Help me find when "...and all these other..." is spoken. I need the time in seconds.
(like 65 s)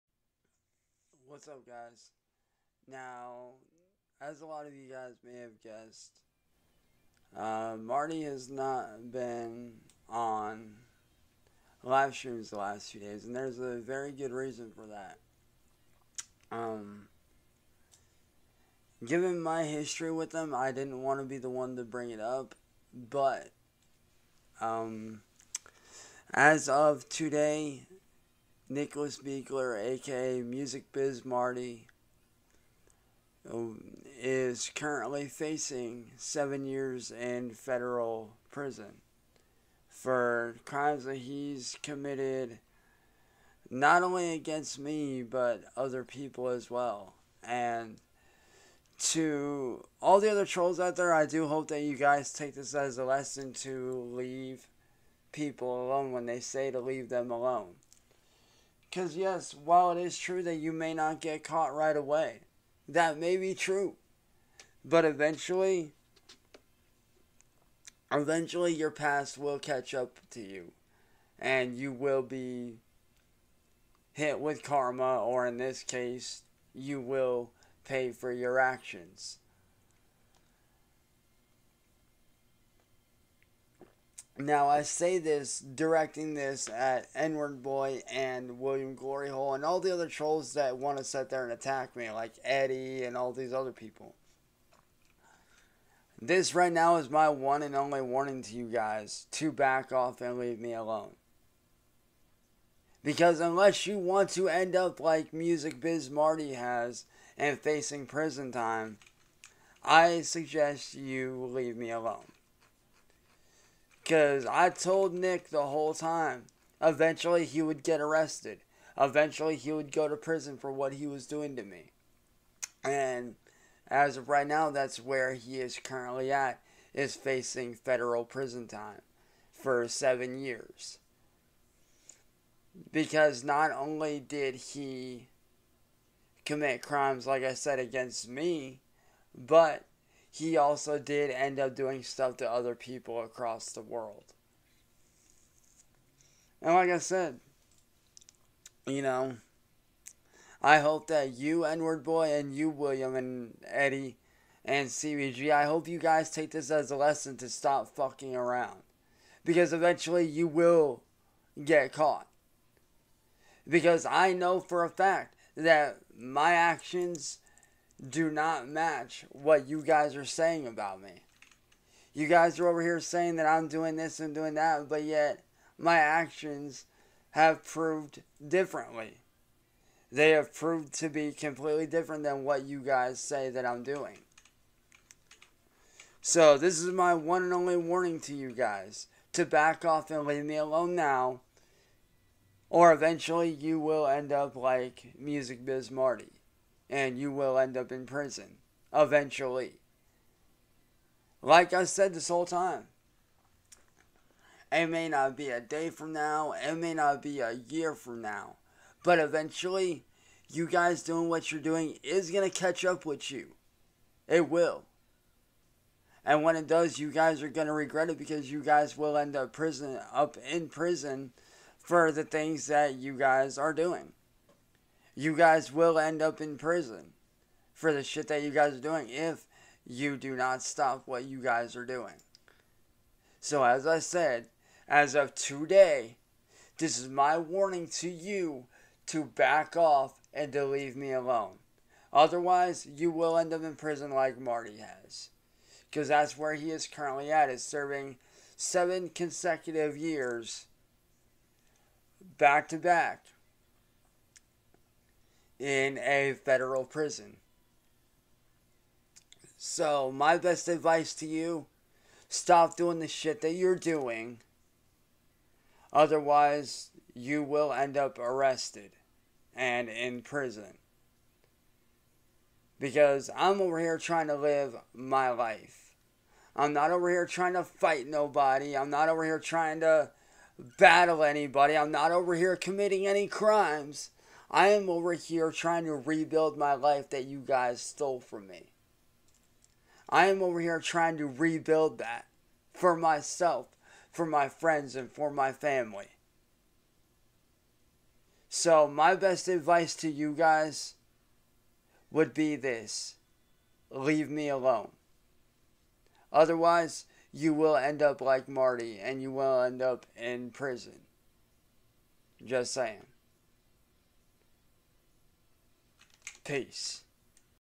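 93 s.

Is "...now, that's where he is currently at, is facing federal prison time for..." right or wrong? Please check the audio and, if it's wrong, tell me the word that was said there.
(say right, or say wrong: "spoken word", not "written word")
right.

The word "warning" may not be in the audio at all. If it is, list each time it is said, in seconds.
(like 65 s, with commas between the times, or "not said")
98 s, 187 s, 237 s.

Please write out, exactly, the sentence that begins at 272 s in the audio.
Because I'm over here trying to live my life.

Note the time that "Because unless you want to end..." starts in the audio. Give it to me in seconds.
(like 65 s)
103 s.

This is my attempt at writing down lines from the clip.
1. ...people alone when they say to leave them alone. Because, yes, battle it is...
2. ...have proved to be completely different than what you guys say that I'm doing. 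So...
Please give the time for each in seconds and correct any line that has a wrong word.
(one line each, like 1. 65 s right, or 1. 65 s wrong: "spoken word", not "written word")
1. 55 s wrong: "while", not "battle"
2. 180 s right.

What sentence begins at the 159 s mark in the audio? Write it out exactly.
Because eventually you will get caught.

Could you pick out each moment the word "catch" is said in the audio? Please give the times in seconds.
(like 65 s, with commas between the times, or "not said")
69 s, 212 s.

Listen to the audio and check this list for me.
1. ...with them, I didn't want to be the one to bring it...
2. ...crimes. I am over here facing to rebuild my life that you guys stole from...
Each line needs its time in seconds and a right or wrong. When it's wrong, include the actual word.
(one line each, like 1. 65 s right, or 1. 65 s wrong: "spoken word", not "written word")
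1. 20 s right
2. 283 s wrong: "trying", not "facing".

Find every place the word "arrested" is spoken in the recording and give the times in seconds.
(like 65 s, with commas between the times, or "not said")
118 s, 268 s.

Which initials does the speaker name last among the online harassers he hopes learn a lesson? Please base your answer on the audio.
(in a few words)
CBG.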